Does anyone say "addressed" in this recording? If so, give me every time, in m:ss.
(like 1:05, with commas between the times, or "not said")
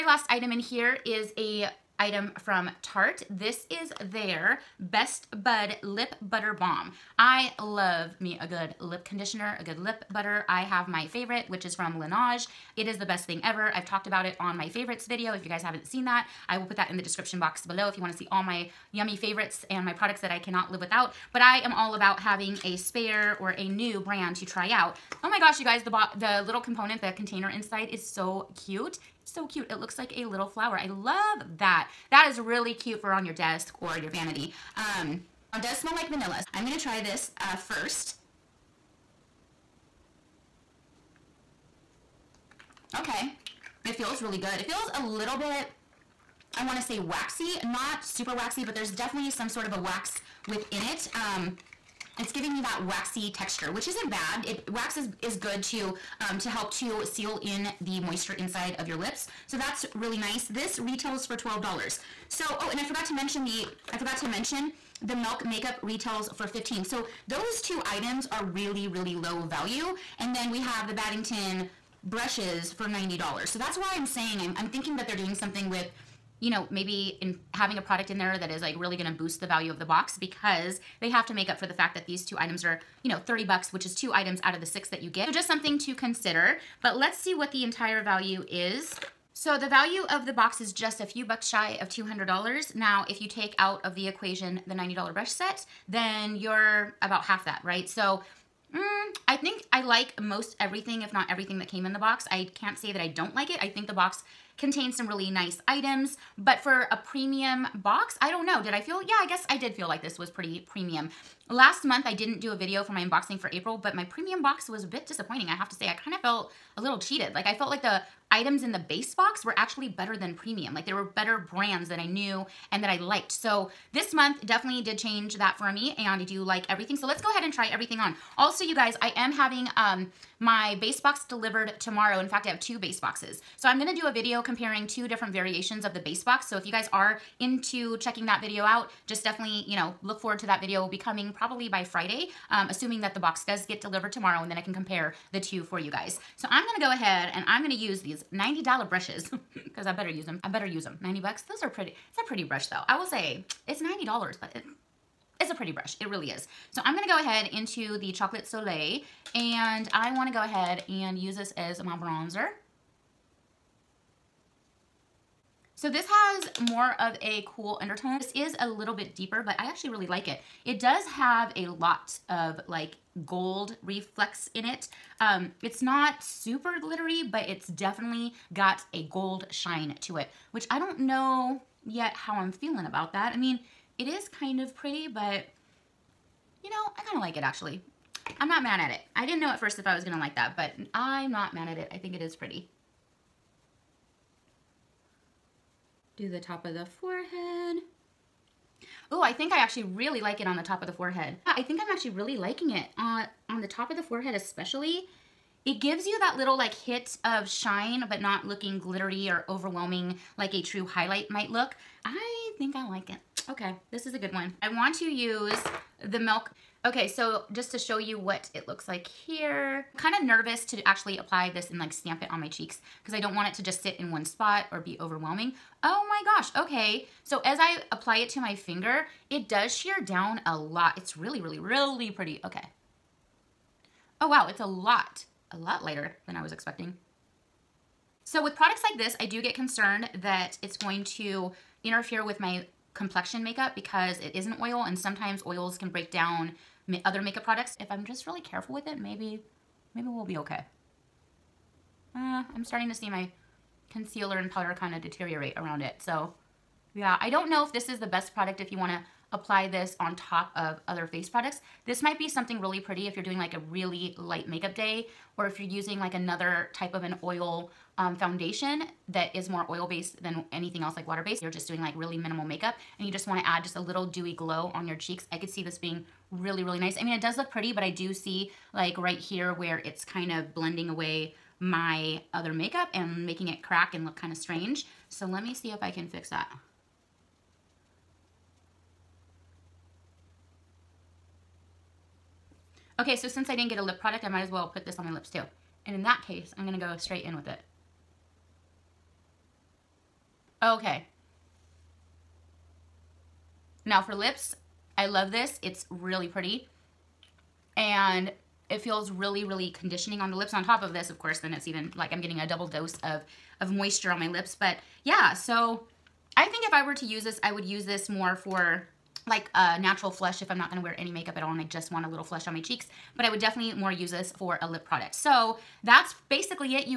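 not said.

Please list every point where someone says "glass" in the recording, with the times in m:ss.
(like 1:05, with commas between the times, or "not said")
not said.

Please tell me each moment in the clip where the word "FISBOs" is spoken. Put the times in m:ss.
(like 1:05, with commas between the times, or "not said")
not said.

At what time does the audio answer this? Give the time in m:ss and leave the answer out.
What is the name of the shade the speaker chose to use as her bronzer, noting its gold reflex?
2:38.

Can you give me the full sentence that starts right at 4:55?
And in that case, I'm gonna go straight in with it.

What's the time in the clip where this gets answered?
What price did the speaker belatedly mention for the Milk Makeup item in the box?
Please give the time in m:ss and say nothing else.
1:06.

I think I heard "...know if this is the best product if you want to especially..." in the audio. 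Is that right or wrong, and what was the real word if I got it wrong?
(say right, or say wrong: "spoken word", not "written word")
wrong: "apply", not "especially".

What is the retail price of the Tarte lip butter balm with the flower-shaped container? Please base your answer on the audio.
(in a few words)
$12.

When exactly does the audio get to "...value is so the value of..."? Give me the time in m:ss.
1:28.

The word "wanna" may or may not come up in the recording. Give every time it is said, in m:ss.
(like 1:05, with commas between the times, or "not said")
0:18, 0:46, 4:33.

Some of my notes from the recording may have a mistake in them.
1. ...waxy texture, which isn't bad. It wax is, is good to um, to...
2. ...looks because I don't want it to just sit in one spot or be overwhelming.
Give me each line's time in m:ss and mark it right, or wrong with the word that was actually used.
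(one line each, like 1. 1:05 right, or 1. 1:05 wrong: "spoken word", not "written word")
1. 0:52 right
2. 3:42 wrong: "cheeks", not "looks".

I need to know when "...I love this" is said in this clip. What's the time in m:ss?
5:04.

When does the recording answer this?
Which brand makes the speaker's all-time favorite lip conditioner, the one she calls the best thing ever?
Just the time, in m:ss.
0:12.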